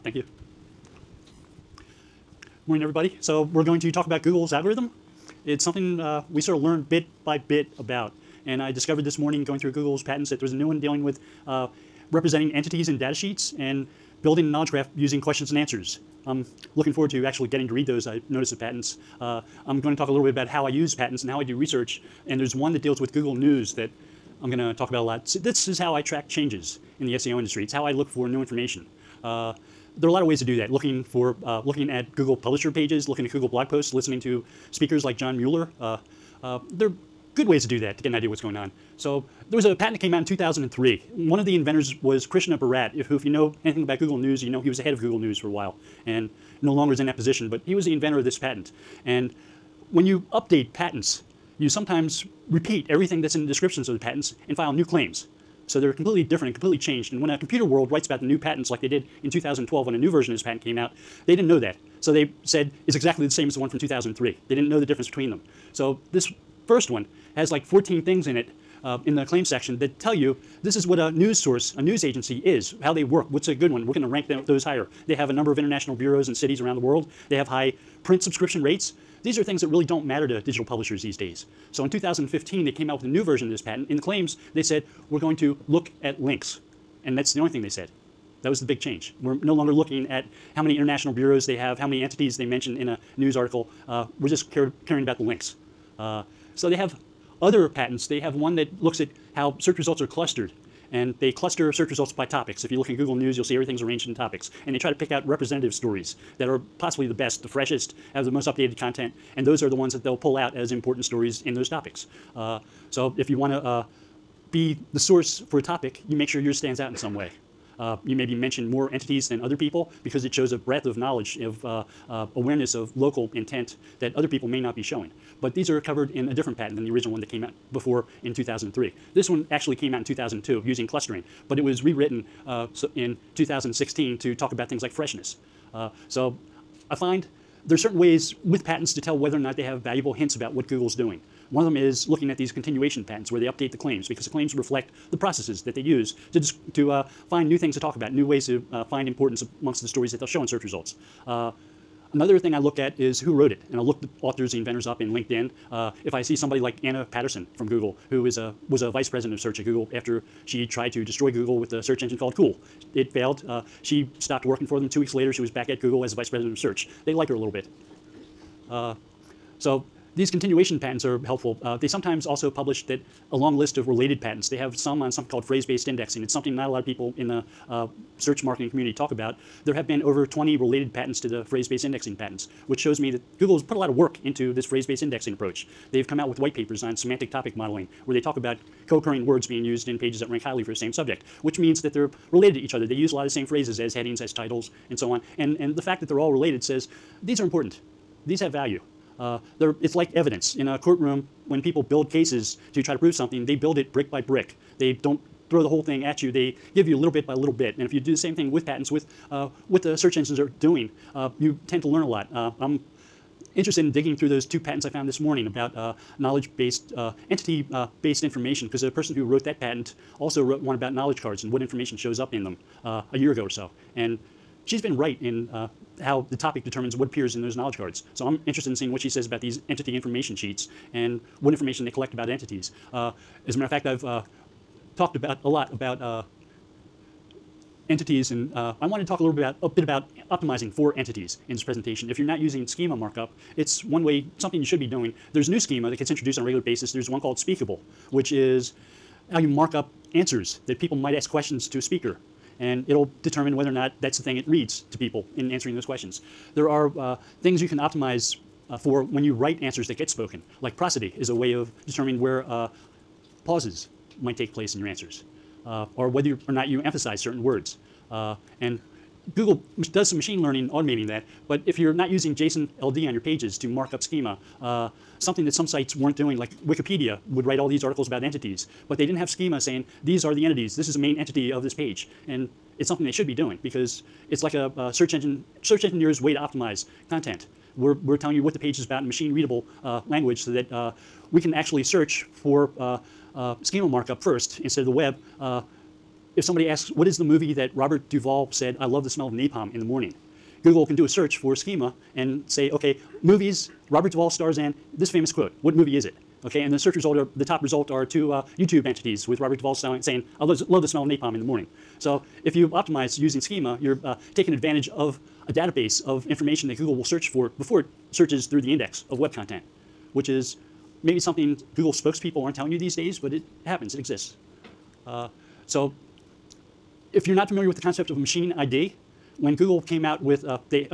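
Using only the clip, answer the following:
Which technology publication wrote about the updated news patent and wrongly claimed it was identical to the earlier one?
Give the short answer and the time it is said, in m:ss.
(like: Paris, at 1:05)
Computerworld, at 0:57.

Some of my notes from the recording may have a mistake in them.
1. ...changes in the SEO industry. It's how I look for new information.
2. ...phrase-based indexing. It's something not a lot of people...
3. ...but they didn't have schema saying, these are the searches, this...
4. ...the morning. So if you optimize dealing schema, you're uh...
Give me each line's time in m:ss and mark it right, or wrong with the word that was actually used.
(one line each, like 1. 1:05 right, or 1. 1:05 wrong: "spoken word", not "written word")
1. 0:26 right
2. 2:55 right
3. 4:38 wrong: "entities", not "searches"
4. 5:11 wrong: "using", not "dealing".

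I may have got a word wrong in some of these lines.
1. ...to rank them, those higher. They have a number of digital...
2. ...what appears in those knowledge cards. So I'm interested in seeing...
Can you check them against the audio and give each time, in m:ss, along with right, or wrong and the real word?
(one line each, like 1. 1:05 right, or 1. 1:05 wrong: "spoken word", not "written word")
1. 1:14 wrong: "international", not "digital"
2. 3:46 right.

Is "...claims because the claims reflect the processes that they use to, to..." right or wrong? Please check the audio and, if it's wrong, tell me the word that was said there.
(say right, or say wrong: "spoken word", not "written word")
right.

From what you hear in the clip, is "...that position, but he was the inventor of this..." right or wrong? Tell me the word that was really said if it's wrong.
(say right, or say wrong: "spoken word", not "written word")
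right.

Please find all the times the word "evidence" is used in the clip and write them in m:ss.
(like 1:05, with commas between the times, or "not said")
3:20.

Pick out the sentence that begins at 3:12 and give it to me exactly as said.
They use a lot of the same phrases as headings, as titles, and so on.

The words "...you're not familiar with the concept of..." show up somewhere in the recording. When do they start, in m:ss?
5:27.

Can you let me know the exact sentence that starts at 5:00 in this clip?
Google can do a search for schema and say, okay, movies, Robert Duvall stars in this famous quote.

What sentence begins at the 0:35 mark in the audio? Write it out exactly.
Uh, uh, there are good ways to do that to get an idea what's going on.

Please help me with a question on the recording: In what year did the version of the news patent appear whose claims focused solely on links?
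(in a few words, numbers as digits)
2015.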